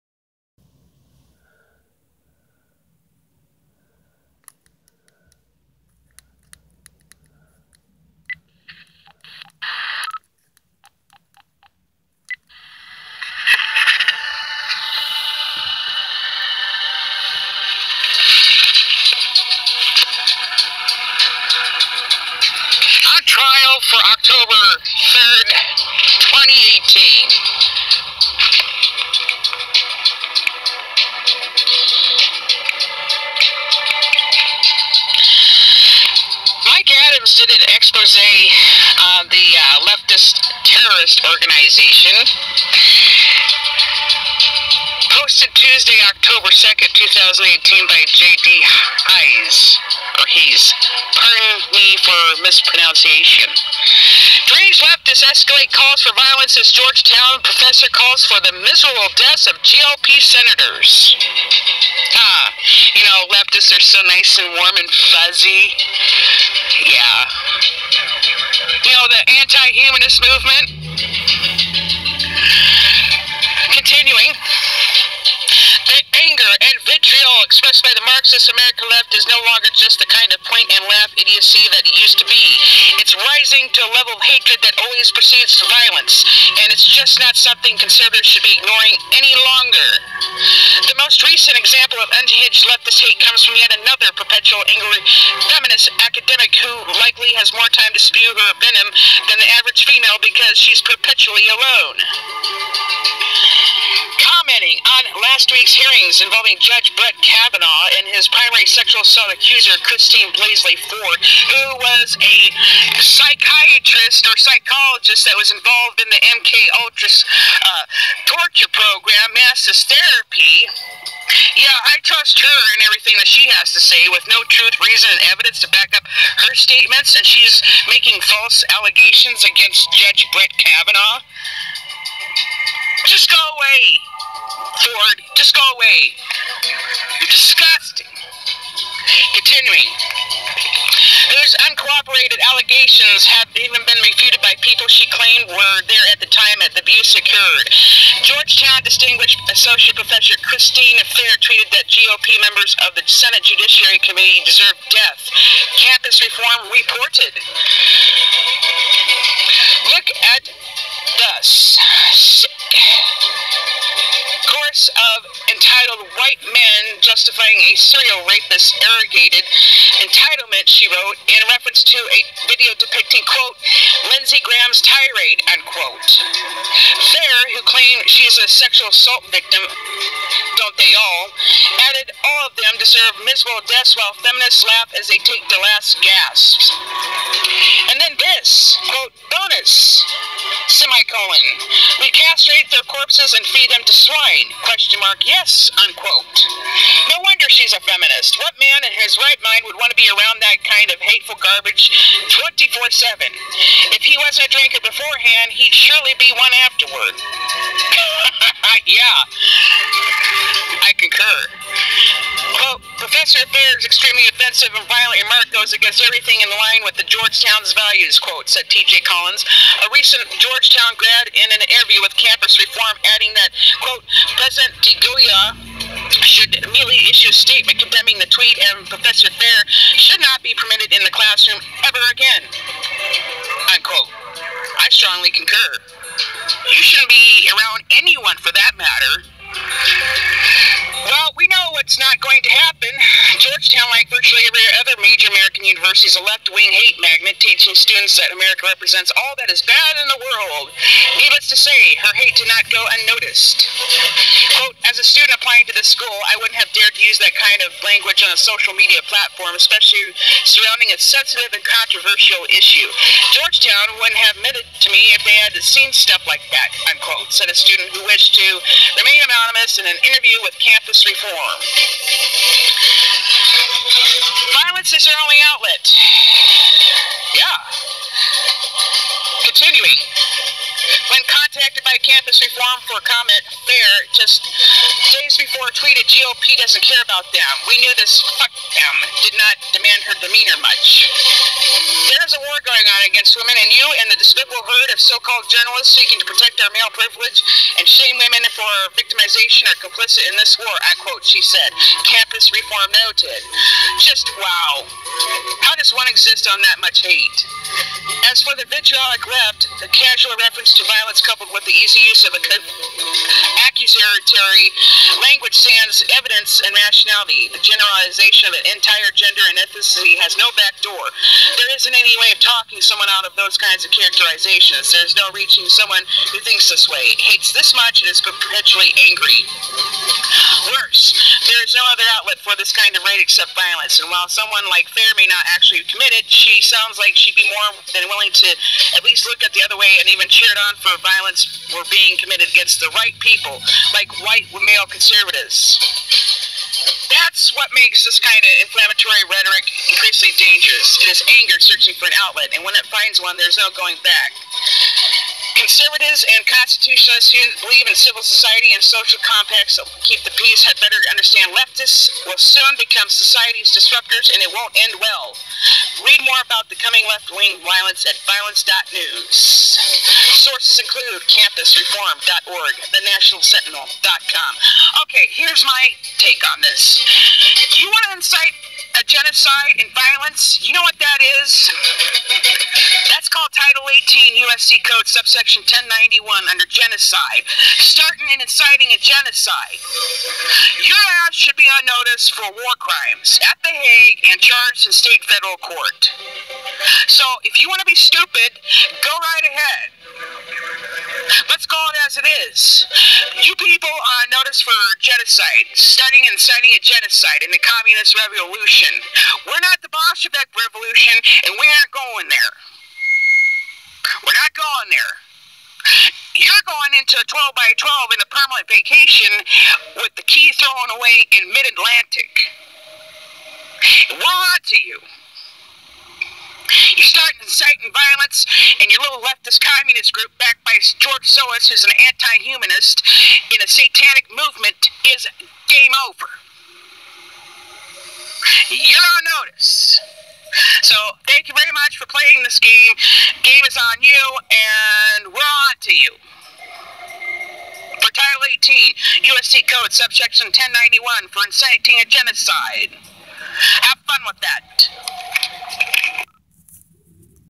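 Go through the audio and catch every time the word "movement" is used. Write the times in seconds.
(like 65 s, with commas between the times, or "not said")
70 s, 434 s.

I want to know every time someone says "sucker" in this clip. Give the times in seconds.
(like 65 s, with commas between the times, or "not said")
not said.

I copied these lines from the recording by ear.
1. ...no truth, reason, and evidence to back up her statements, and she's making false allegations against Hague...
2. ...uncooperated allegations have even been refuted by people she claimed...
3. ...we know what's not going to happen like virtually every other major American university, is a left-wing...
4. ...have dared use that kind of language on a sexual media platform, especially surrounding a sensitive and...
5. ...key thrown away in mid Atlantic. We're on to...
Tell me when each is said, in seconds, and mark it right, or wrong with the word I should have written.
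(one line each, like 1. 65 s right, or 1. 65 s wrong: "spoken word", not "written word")
1. 124 s wrong: "Judge", not "Hague"
2. 141 s right
3. 241 s right
4. 256 s wrong: "social", not "sexual"
5. 420 s right.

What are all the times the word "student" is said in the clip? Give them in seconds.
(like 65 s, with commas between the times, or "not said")
247 s, 255 s, 267 s.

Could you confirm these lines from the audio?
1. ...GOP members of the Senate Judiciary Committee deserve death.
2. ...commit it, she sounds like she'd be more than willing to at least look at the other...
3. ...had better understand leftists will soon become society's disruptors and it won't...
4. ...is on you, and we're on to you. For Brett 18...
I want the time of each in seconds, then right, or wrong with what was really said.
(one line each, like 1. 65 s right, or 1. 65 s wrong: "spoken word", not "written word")
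1. 151 s right
2. 335 s right
3. 360 s right
4. 443 s wrong: "Title", not "Brett".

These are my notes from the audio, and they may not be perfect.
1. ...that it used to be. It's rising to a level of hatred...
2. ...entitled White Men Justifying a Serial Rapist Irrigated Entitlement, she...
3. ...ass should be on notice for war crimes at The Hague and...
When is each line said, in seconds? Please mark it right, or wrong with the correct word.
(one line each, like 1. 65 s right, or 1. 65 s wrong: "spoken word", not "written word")
1. 81 s right
2. 165 s right
3. 391 s right.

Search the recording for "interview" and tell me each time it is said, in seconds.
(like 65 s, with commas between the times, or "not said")
221 s, 270 s.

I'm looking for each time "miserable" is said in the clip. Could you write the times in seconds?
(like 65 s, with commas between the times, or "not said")
58 s, 183 s.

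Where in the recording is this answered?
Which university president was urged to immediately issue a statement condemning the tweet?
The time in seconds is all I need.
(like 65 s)
224 s.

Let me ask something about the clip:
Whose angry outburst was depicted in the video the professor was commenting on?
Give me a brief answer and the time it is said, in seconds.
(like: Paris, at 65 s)
Lindsey Graham, at 174 s.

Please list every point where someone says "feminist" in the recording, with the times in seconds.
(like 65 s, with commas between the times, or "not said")
95 s, 184 s, 197 s.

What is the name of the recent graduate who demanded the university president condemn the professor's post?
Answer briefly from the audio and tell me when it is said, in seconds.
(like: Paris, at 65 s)
T.J. Collins, at 218 s.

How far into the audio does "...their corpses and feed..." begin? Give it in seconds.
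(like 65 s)
192 s.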